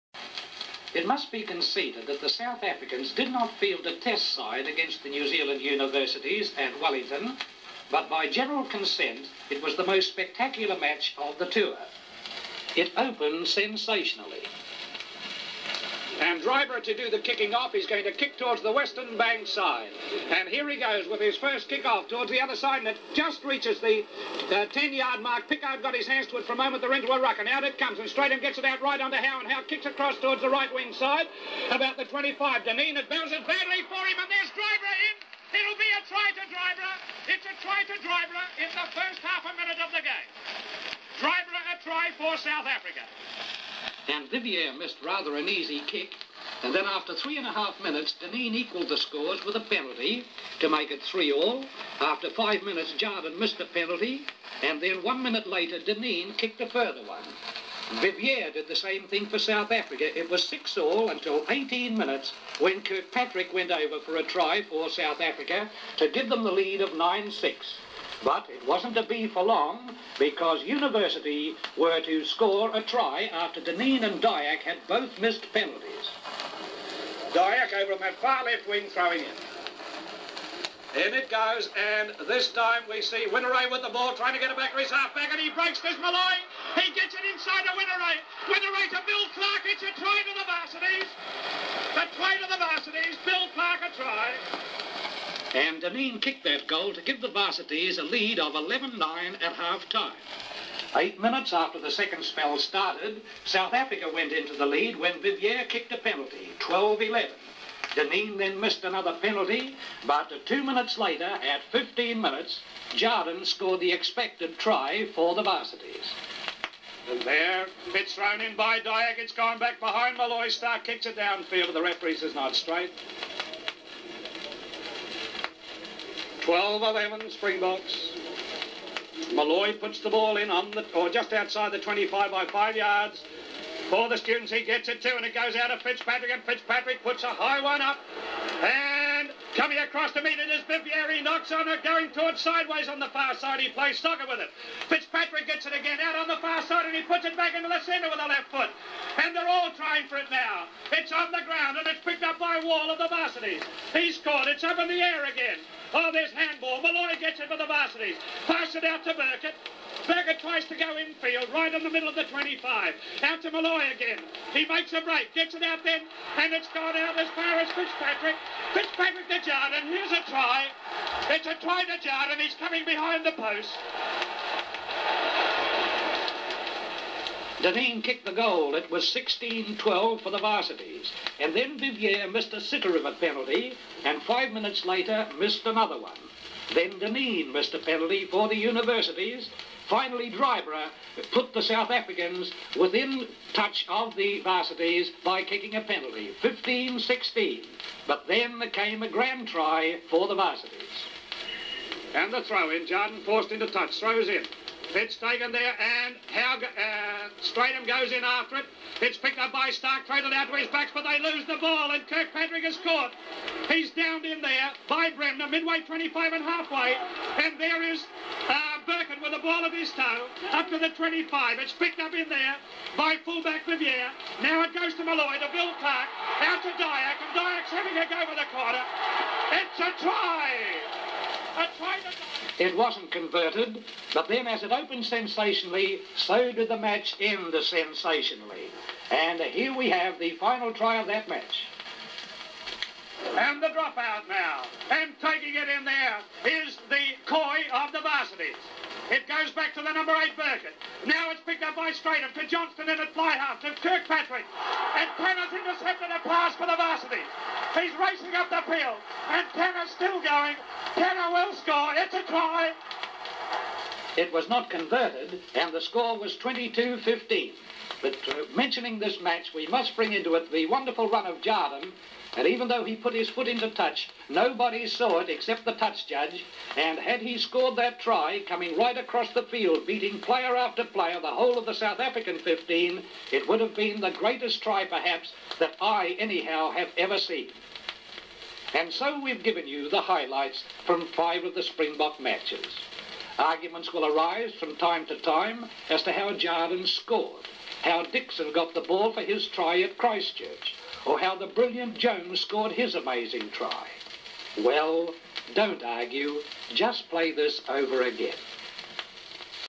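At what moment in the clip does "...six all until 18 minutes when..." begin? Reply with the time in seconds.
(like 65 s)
60 s.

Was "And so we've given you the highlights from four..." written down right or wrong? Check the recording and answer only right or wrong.
wrong.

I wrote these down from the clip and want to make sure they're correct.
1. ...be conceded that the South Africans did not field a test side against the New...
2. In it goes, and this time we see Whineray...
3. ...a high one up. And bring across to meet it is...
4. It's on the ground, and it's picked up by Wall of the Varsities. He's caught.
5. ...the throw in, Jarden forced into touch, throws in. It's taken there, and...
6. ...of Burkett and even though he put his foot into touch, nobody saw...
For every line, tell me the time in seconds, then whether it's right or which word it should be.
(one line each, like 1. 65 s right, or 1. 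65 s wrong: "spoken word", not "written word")
1. 1 s right
2. 81 s right
3. 137 s wrong: "coming", not "bring"
4. 150 s right
5. 202 s right
6. 271 s wrong: "Jarden", not "Burkett".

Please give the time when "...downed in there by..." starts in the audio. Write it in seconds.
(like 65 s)
213 s.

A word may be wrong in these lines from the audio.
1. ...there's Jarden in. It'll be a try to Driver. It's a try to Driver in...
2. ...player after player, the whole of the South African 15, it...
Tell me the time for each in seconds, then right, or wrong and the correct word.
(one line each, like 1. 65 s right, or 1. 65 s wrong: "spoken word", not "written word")
1. 34 s wrong: "Driver", not "Jarden"
2. 280 s right.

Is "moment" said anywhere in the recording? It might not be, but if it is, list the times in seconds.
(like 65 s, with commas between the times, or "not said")
26 s.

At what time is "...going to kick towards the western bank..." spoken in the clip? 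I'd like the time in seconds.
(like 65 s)
17 s.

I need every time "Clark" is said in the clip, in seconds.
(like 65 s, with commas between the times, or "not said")
89 s, 93 s, 225 s.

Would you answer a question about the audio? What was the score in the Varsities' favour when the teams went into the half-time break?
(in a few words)
11-9.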